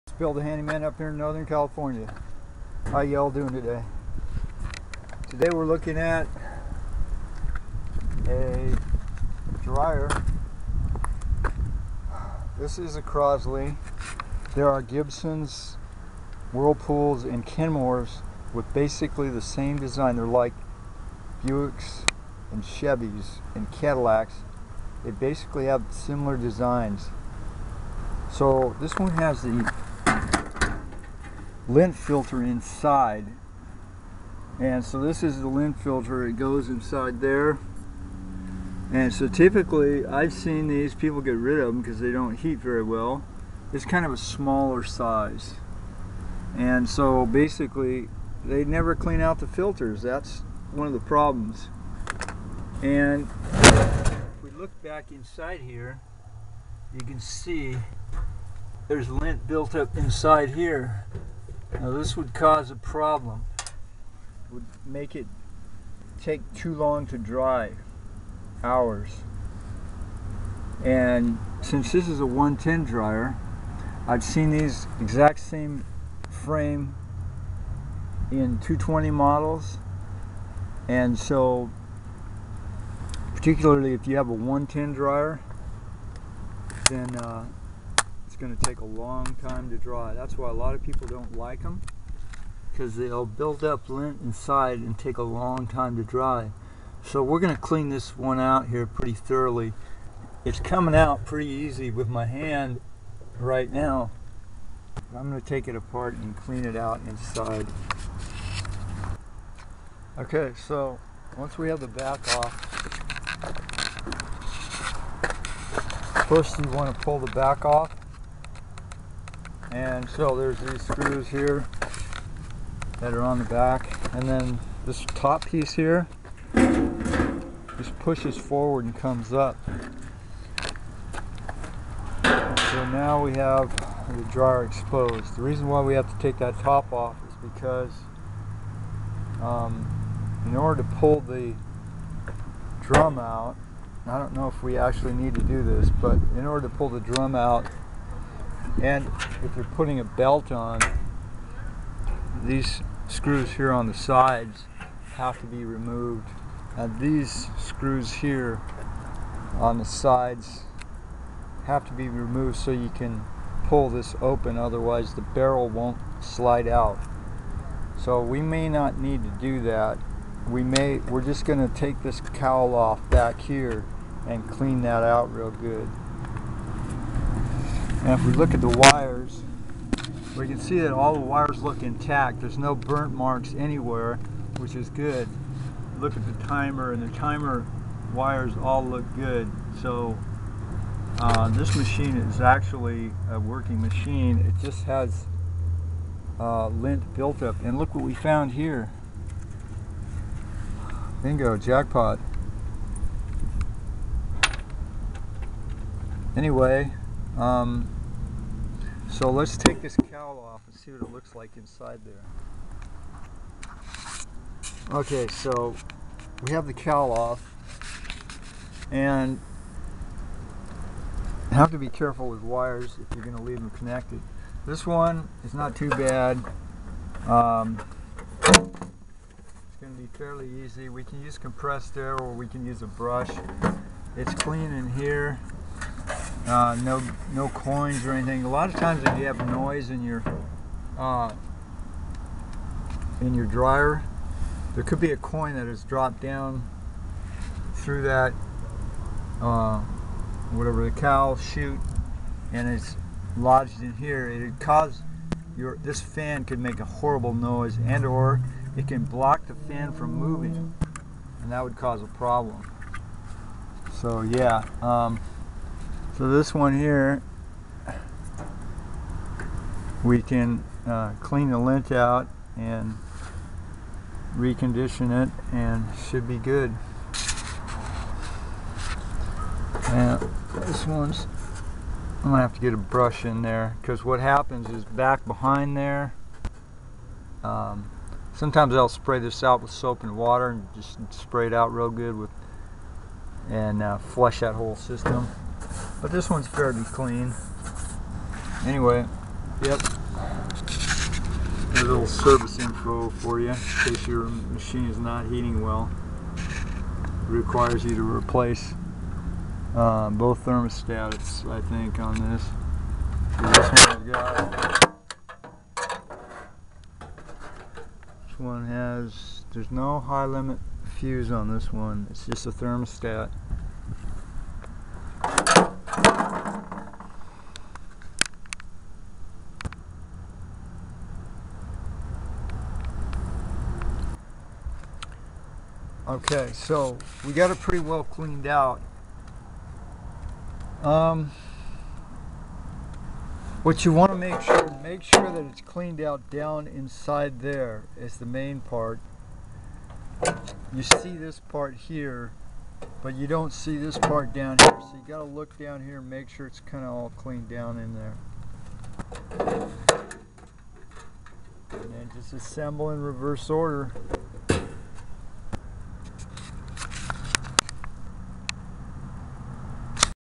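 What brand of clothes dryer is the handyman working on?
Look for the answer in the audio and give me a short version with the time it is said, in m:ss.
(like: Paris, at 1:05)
Crosley, at 0:13.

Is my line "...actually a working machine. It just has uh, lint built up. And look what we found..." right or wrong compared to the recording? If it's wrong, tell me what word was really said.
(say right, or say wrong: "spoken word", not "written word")
right.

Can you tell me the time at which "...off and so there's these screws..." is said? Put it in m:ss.
1:57.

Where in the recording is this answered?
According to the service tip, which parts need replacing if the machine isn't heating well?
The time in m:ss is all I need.
5:10.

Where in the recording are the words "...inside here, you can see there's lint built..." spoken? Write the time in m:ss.
0:55.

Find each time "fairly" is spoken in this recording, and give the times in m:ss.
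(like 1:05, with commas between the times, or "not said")
3:50, 4:56.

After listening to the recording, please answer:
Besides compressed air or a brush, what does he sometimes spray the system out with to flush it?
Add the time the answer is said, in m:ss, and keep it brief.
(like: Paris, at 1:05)
Soap and water, at 4:49.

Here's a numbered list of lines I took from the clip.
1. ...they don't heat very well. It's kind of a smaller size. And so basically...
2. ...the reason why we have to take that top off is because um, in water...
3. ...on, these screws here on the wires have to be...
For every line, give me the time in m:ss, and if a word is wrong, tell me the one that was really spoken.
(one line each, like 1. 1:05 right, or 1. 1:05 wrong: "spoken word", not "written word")
1. 0:41 right
2. 2:15 wrong: "order", not "water"
3. 2:30 wrong: "sides", not "wires".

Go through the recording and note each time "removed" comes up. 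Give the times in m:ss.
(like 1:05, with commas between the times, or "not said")
2:35, 2:42.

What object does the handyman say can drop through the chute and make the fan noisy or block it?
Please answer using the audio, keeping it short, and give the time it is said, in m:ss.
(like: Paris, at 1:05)
A coin, at 4:05.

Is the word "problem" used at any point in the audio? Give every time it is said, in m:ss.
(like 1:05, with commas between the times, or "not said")
0:50, 1:02, 4:22.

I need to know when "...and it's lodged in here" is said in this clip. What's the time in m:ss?
4:12.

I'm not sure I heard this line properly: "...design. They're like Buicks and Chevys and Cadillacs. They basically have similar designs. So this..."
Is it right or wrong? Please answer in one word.
right.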